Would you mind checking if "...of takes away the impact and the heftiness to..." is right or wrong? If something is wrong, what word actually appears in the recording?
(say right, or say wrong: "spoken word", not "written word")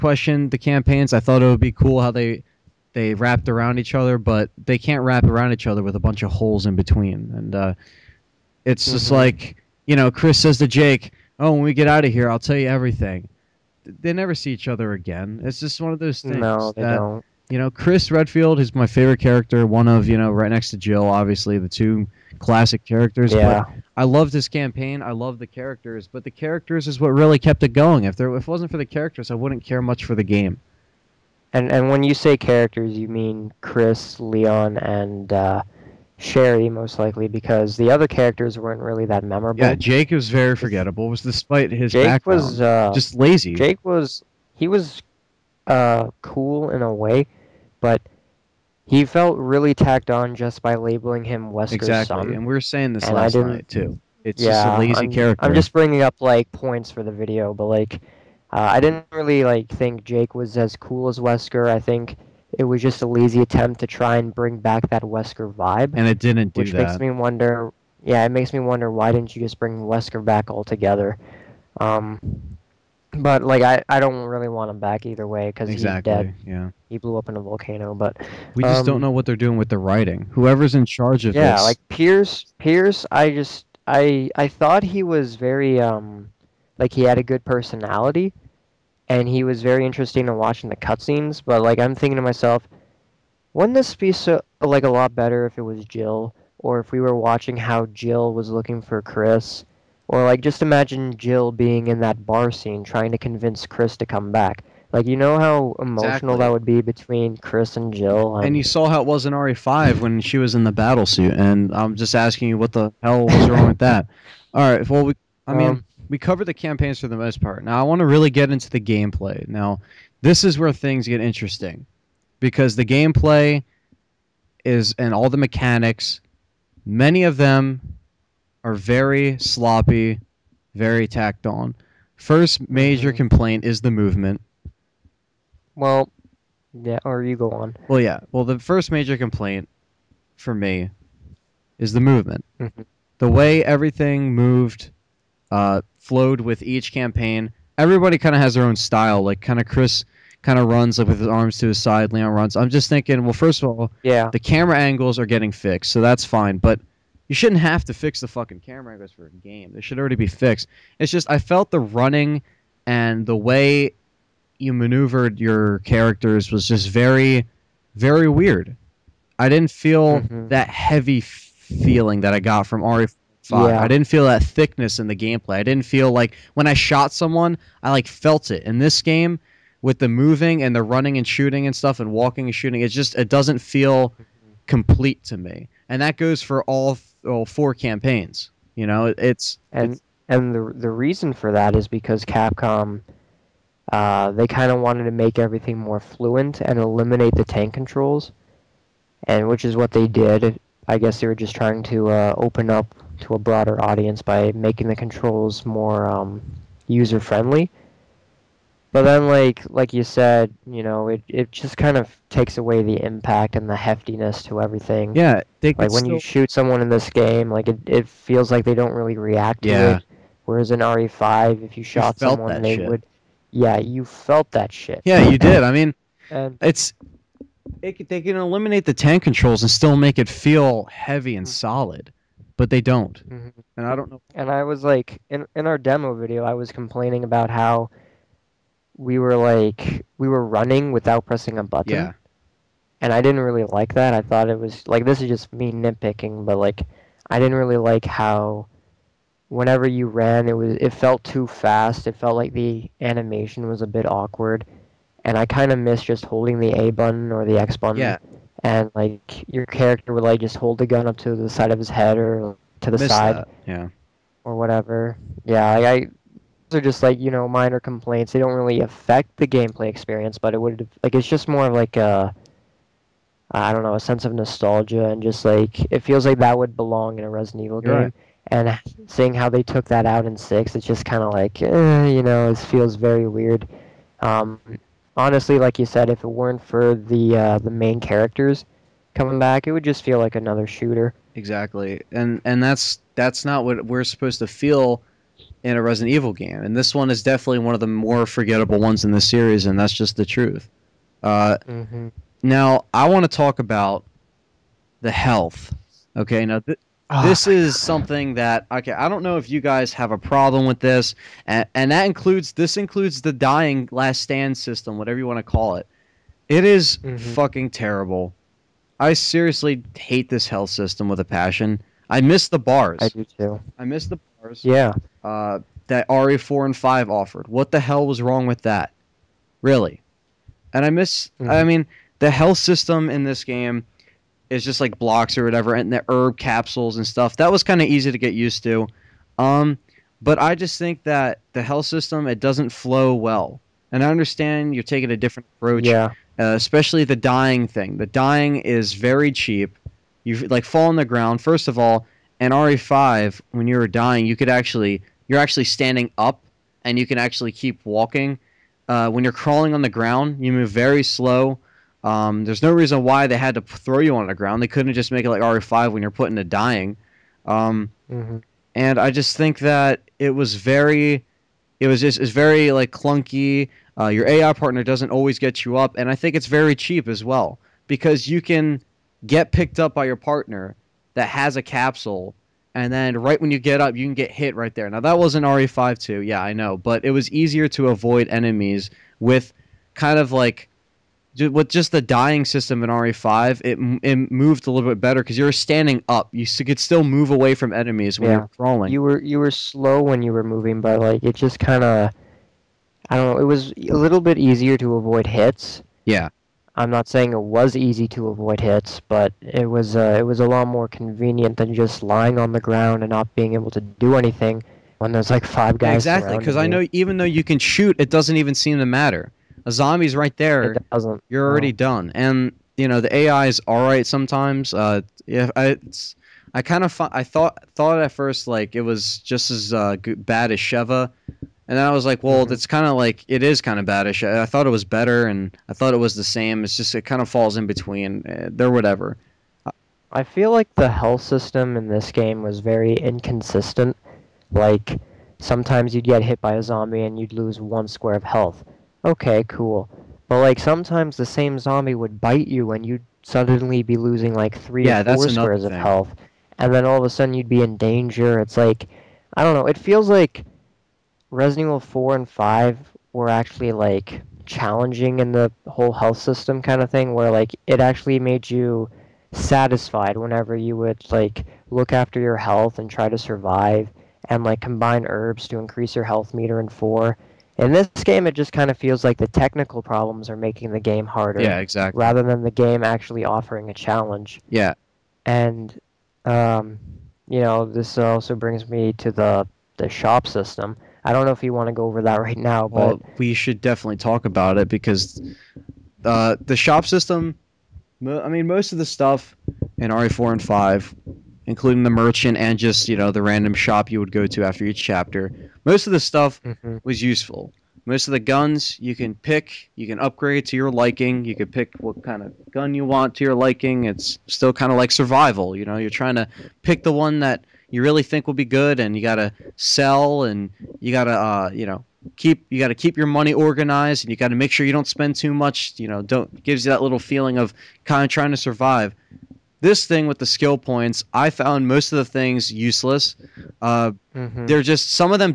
right.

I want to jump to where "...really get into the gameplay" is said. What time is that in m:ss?
1:58.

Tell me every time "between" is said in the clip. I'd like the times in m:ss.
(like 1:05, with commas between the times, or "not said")
0:06, 1:46, 7:17.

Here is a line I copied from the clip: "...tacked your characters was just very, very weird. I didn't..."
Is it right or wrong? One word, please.
wrong.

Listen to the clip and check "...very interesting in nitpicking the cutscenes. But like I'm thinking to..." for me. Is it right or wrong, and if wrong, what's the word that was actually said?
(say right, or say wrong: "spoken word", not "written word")
wrong: "watching", not "nitpicking".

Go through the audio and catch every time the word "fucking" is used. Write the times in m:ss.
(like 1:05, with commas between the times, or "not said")
2:38, 5:17.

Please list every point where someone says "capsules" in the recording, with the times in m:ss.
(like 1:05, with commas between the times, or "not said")
5:36, 6:21.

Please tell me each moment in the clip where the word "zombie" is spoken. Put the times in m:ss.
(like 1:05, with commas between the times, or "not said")
6:59, 7:26, 7:31.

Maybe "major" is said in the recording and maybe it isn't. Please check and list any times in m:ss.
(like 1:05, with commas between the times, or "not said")
2:12, 2:18.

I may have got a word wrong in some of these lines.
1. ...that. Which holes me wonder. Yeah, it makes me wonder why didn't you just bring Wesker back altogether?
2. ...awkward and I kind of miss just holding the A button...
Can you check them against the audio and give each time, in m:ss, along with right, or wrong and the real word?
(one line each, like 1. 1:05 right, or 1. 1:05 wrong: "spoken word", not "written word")
1. 1:06 wrong: "makes", not "holes"
2. 4:14 right.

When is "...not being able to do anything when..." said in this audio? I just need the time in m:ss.
6:53.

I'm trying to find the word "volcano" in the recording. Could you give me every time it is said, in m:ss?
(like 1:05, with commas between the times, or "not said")
1:17.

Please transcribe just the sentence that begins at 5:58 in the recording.
Uh, when you're crawling on the ground, you move very slow.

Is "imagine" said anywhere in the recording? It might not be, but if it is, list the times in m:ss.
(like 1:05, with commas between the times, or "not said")
1:40.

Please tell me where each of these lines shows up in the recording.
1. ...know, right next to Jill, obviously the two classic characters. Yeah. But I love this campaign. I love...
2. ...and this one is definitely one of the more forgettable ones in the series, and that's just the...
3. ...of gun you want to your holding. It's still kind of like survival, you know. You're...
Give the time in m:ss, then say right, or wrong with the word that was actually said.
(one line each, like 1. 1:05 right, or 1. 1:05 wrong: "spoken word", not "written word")
1. 0:20 right
2. 4:56 right
3. 8:32 wrong: "liking", not "holding".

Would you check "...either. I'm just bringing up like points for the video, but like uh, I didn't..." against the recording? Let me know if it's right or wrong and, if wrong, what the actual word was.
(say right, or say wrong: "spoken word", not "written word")
wrong: "character", not "either".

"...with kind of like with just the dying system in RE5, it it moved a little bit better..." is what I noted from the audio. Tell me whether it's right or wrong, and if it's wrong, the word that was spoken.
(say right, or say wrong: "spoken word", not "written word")
right.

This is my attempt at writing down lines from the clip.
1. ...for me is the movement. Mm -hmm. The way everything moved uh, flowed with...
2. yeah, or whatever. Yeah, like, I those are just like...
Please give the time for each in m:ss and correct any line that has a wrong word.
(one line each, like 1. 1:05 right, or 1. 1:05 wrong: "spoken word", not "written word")
1. 2:20 right
2. 4:23 right.